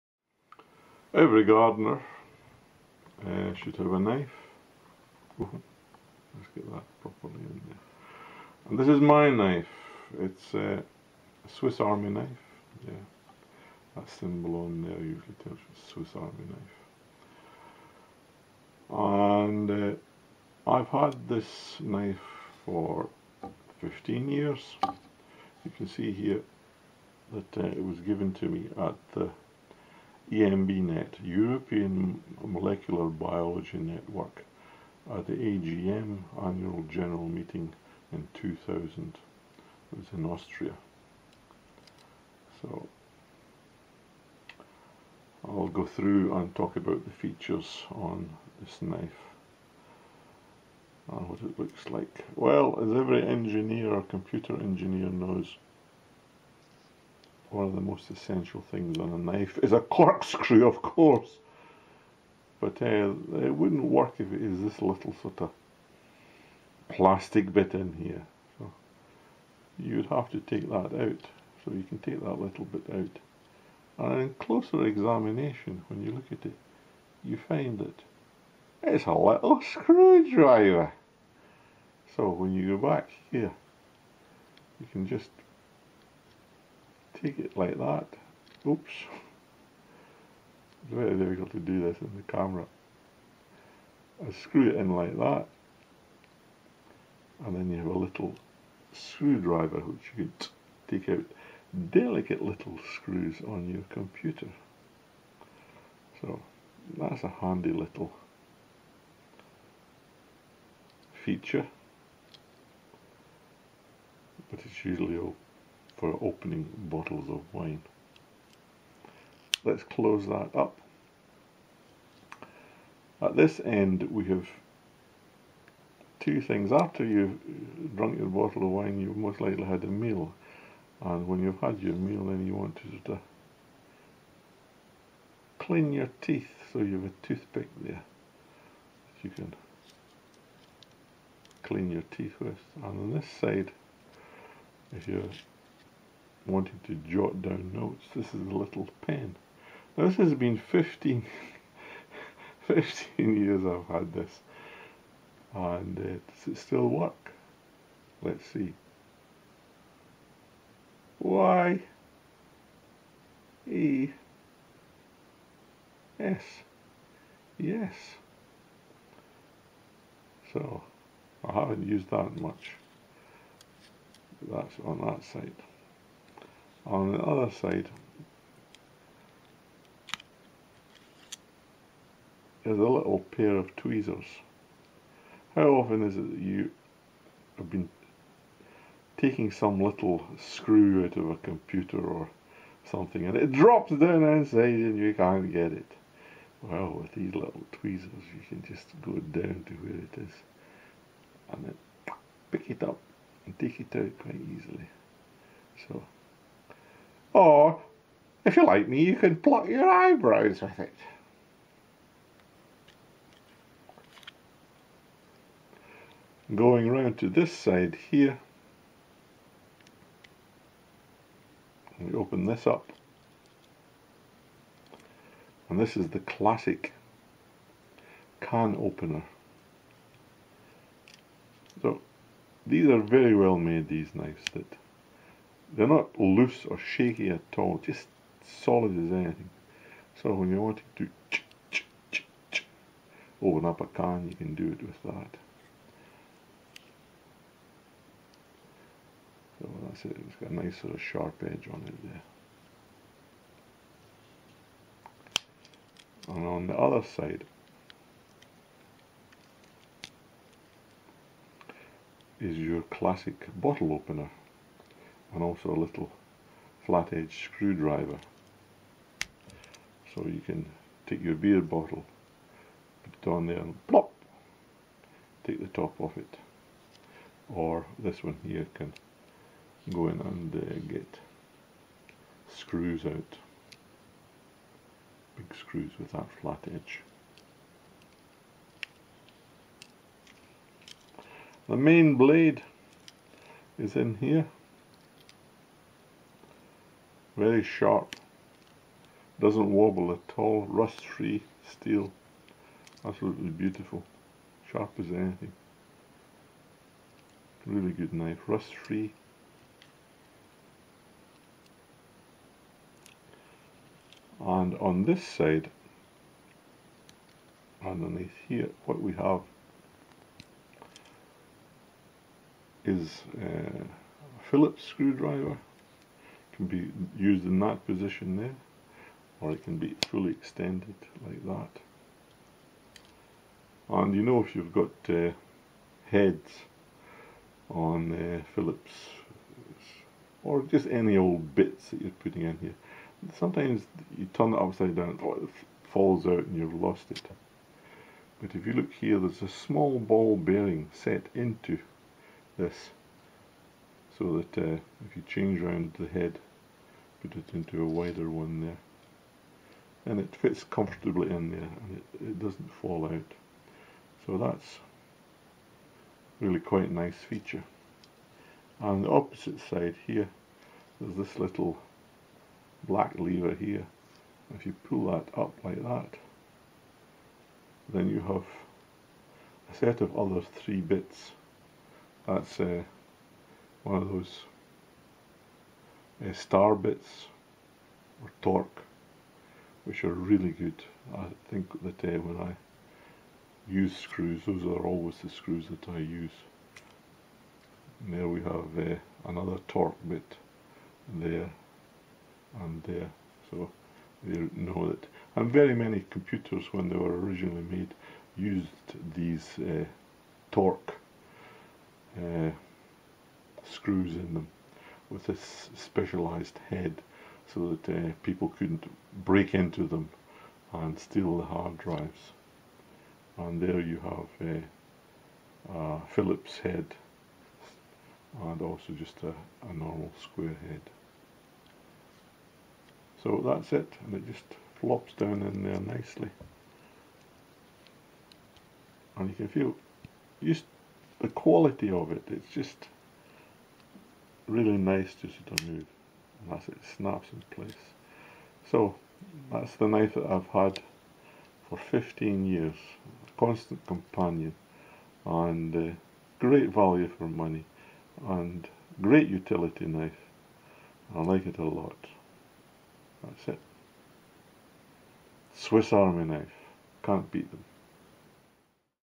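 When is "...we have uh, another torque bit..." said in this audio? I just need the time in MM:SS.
06:38.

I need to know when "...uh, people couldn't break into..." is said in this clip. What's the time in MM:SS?
06:57.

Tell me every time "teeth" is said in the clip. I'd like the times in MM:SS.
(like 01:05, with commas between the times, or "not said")
02:16, 02:22.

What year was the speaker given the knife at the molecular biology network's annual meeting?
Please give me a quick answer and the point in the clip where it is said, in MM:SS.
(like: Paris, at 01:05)
2000, at 00:38.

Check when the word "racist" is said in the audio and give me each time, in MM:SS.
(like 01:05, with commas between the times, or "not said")
not said.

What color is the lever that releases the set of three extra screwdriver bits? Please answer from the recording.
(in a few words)
Black.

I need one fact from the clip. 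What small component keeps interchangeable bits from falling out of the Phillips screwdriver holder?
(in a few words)
Ball bearing.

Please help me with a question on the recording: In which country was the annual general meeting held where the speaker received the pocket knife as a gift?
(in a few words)
Austria.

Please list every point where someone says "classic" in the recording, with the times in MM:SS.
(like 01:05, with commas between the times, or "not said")
03:46, 04:22.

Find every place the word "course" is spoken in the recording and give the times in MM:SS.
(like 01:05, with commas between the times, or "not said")
01:00.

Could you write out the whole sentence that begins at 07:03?
And there you have a, uh, a Phillips head and also just a, a normal square head.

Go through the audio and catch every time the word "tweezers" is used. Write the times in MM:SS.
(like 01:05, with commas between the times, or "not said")
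03:03, 03:17.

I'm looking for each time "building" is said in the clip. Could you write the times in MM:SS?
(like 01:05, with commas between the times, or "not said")
not said.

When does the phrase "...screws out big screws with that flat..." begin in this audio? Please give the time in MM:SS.
04:42.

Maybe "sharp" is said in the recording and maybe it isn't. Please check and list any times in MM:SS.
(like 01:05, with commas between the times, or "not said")
04:11, 04:57, 05:04.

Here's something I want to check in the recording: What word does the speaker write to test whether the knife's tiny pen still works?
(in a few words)
Yes.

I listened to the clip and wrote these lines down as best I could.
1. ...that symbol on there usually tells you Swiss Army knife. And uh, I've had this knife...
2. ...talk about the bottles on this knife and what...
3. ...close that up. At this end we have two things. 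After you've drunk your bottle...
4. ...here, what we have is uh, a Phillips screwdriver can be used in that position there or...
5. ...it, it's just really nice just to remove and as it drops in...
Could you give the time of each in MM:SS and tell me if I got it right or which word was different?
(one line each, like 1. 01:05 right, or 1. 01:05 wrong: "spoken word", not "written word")
1. 00:13 right
2. 00:46 wrong: "features", not "bottles"
3. 01:59 right
4. 05:18 right
5. 07:22 wrong: "snaps", not "drops".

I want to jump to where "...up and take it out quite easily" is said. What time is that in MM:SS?
03:22.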